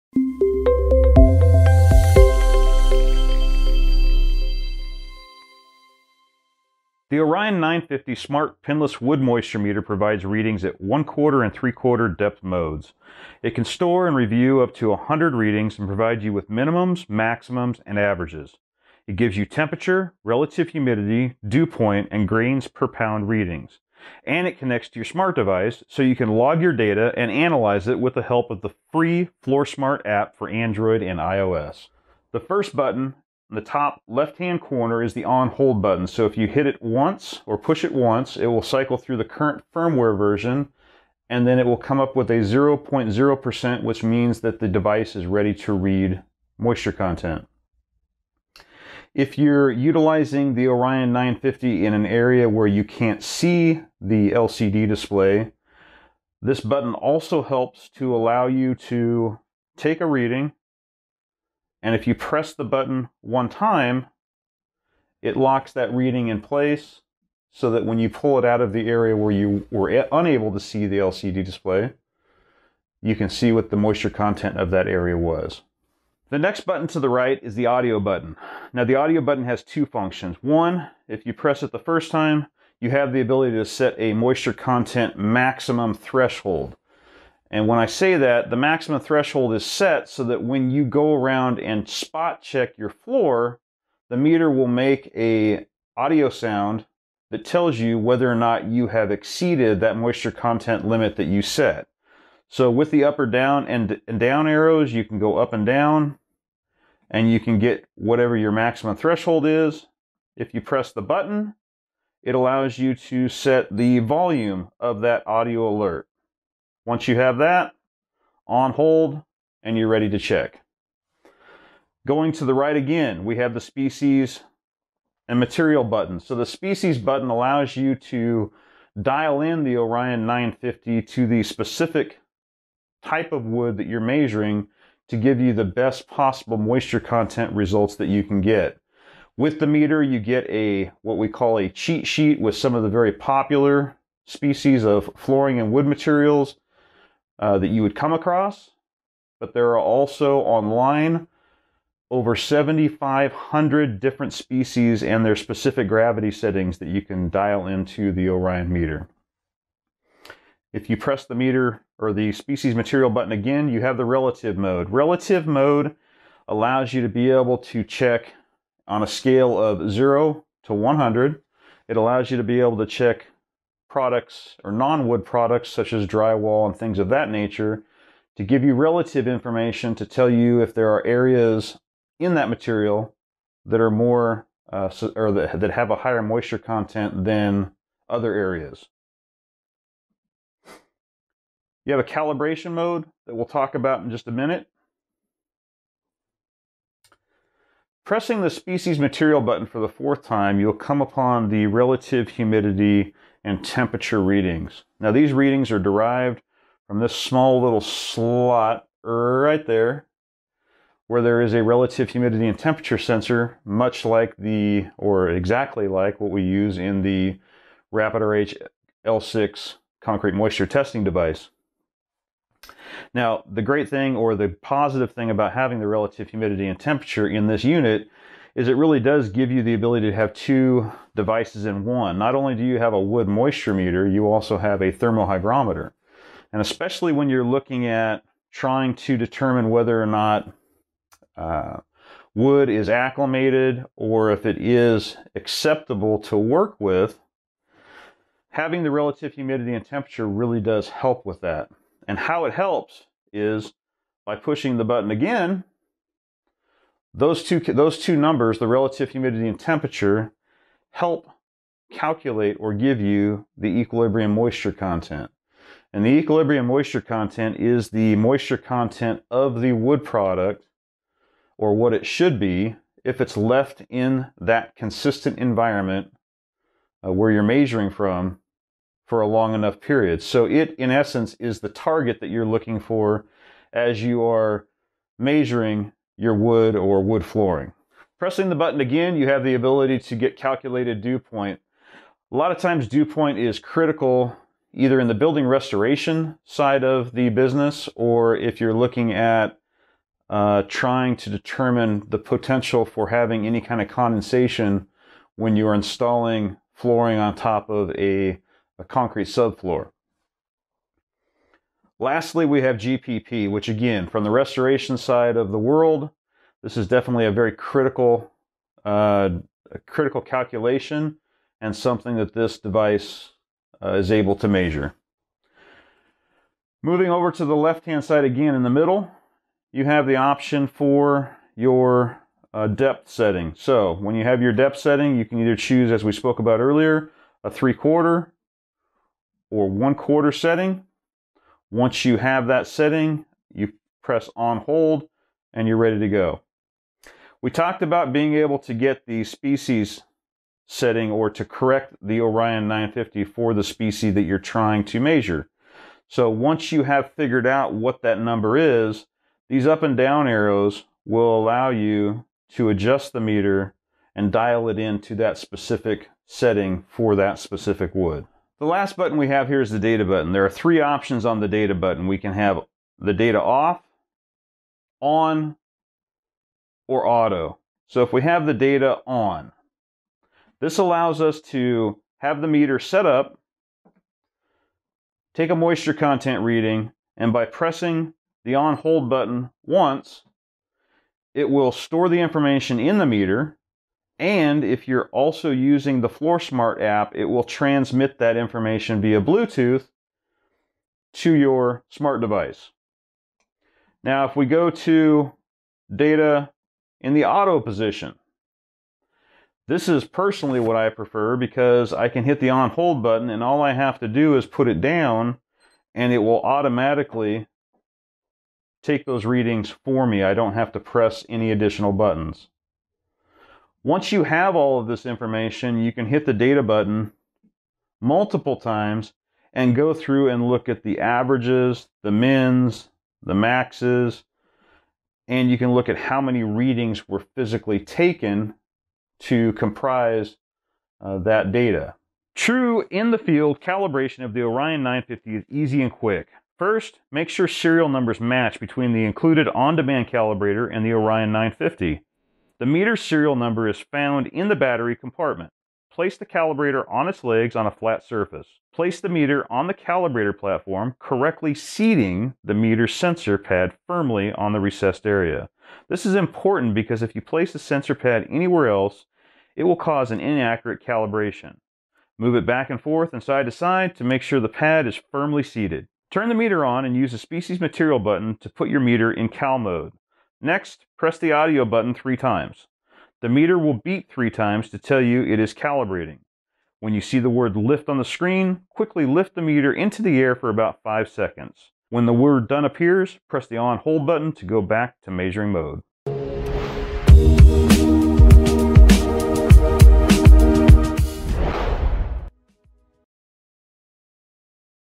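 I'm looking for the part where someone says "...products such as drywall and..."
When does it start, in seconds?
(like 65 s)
175 s.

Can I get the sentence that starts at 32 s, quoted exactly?
The first button in the top left-hand corner is the on hold button.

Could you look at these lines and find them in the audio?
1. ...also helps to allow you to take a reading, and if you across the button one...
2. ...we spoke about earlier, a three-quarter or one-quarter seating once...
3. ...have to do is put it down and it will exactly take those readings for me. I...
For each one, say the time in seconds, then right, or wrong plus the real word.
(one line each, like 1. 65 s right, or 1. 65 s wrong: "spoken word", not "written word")
1. 56 s wrong: "press", not "across"
2. 336 s wrong: "setting", not "seating"
3. 413 s wrong: "automatically", not "exactly".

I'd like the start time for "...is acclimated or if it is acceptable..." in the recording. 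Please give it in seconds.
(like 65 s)
242 s.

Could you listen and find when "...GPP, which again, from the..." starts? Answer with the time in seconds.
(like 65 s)
312 s.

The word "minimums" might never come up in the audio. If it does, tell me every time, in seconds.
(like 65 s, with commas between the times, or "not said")
16 s.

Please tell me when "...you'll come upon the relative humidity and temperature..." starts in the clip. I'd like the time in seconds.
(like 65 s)
200 s.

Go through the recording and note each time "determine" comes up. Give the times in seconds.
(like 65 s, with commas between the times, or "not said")
239 s, 301 s.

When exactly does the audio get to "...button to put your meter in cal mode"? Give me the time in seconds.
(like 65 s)
477 s.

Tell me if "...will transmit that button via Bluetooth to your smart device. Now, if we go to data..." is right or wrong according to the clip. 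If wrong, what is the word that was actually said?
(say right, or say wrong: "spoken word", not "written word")
wrong: "information", not "button".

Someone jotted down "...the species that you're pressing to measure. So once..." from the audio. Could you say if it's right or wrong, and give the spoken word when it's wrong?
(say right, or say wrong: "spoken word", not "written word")
wrong: "trying", not "pressing".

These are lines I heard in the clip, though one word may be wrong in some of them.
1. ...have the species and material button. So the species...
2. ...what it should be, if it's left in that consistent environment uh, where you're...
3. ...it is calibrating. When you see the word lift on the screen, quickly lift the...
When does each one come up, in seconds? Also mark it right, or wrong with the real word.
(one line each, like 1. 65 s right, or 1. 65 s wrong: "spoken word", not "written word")
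1. 123 s right
2. 271 s right
3. 485 s right.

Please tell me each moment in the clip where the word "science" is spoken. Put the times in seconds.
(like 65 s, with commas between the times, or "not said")
not said.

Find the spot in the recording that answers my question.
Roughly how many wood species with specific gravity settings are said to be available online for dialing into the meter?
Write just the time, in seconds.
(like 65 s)
152 s.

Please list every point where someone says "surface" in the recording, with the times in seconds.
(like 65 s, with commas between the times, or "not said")
458 s.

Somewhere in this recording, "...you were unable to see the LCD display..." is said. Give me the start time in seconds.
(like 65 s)
69 s.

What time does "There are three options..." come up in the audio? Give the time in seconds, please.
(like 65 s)
370 s.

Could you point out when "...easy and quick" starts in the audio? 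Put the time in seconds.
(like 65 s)
445 s.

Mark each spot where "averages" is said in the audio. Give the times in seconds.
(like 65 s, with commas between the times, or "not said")
17 s, 430 s.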